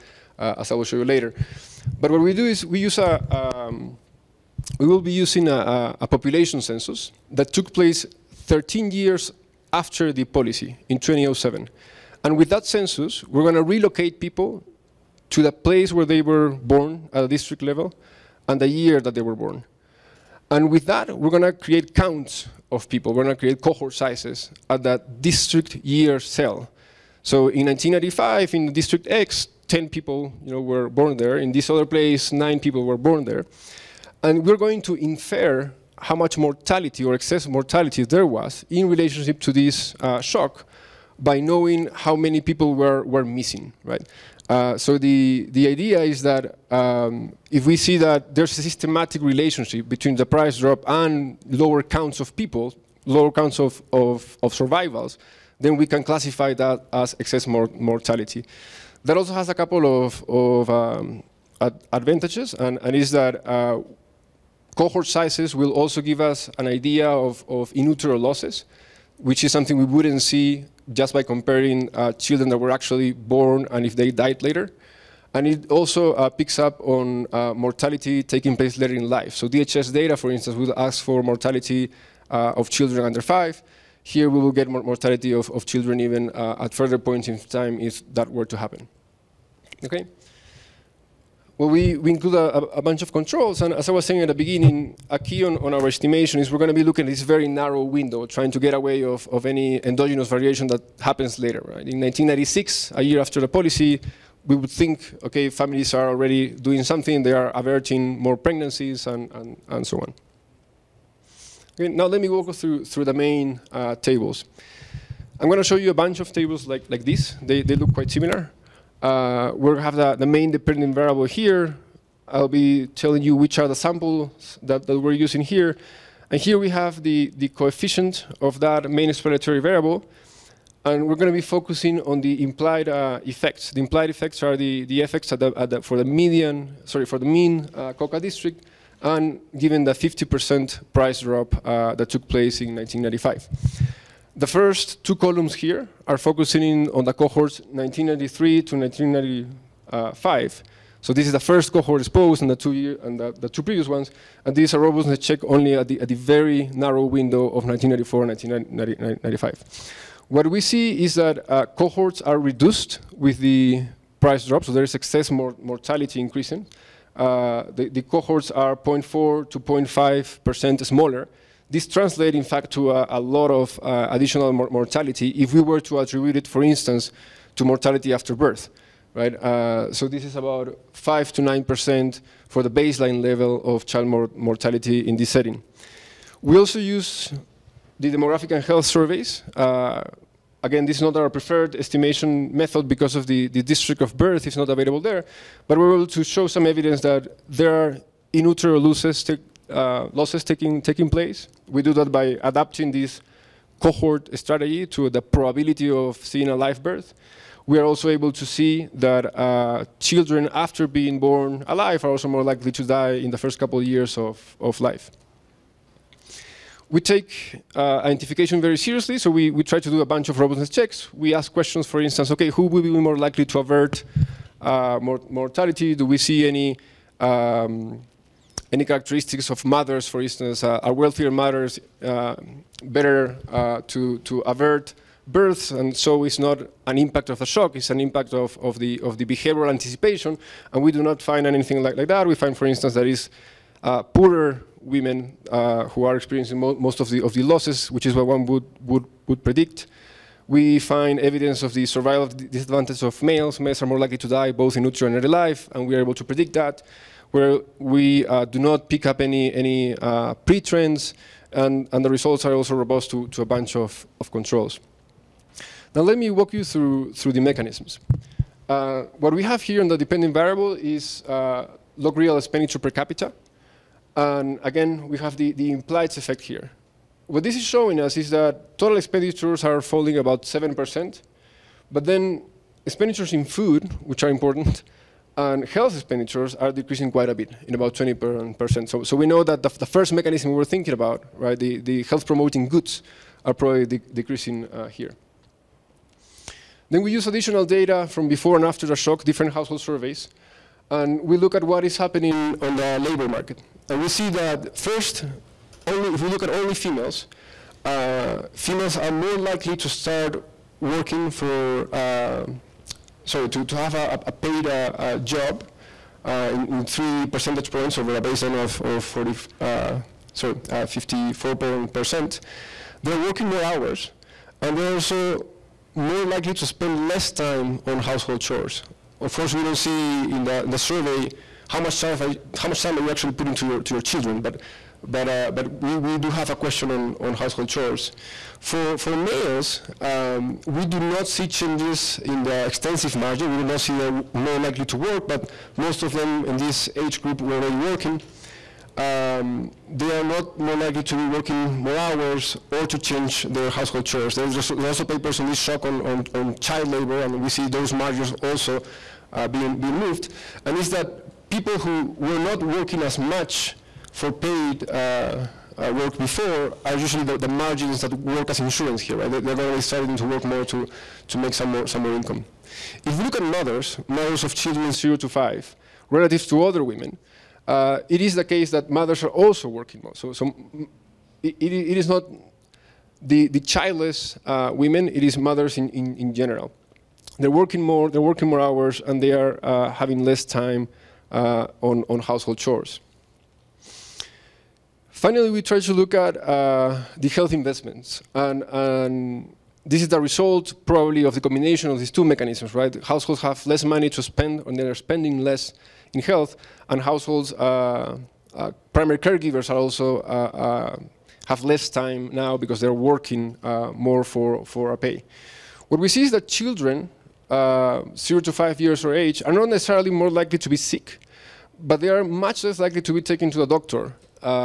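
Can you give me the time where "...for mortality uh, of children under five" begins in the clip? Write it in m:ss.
1:21.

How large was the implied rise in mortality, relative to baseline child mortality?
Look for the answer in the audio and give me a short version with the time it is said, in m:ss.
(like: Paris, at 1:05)
5 to 9%, at 3:00.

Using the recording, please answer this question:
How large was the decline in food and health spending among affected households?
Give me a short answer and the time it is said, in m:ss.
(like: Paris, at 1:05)
20%, at 4:47.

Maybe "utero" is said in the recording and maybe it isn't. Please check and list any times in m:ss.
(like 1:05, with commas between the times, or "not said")
1:07, 3:18, 4:14.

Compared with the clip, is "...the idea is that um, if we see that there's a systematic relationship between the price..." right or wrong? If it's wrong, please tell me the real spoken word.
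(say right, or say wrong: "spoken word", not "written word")
right.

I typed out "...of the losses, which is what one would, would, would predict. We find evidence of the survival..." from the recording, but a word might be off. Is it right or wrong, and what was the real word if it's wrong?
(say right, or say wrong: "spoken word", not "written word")
right.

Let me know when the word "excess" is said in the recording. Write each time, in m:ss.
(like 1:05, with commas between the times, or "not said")
0:37, 0:57, 2:44.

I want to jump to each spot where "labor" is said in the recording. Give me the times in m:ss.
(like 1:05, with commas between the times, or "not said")
5:02, 5:56.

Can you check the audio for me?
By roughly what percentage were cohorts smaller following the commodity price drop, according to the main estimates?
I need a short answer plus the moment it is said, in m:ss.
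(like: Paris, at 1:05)
0.4 to 0.5%, at 2:48.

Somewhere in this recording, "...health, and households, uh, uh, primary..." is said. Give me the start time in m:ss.
6:46.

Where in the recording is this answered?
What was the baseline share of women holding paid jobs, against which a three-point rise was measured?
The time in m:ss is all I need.
5:20.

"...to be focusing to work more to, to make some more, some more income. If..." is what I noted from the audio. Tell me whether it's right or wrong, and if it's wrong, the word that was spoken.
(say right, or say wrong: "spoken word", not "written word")
wrong: "starting", not "focusing".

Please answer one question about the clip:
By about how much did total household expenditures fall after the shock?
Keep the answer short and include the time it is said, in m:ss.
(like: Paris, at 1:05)
7%, at 4:40.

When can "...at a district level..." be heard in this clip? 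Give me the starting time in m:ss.
0:17.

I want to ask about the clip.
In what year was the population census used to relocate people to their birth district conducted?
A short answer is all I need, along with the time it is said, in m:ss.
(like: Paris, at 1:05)
2007, at 0:10.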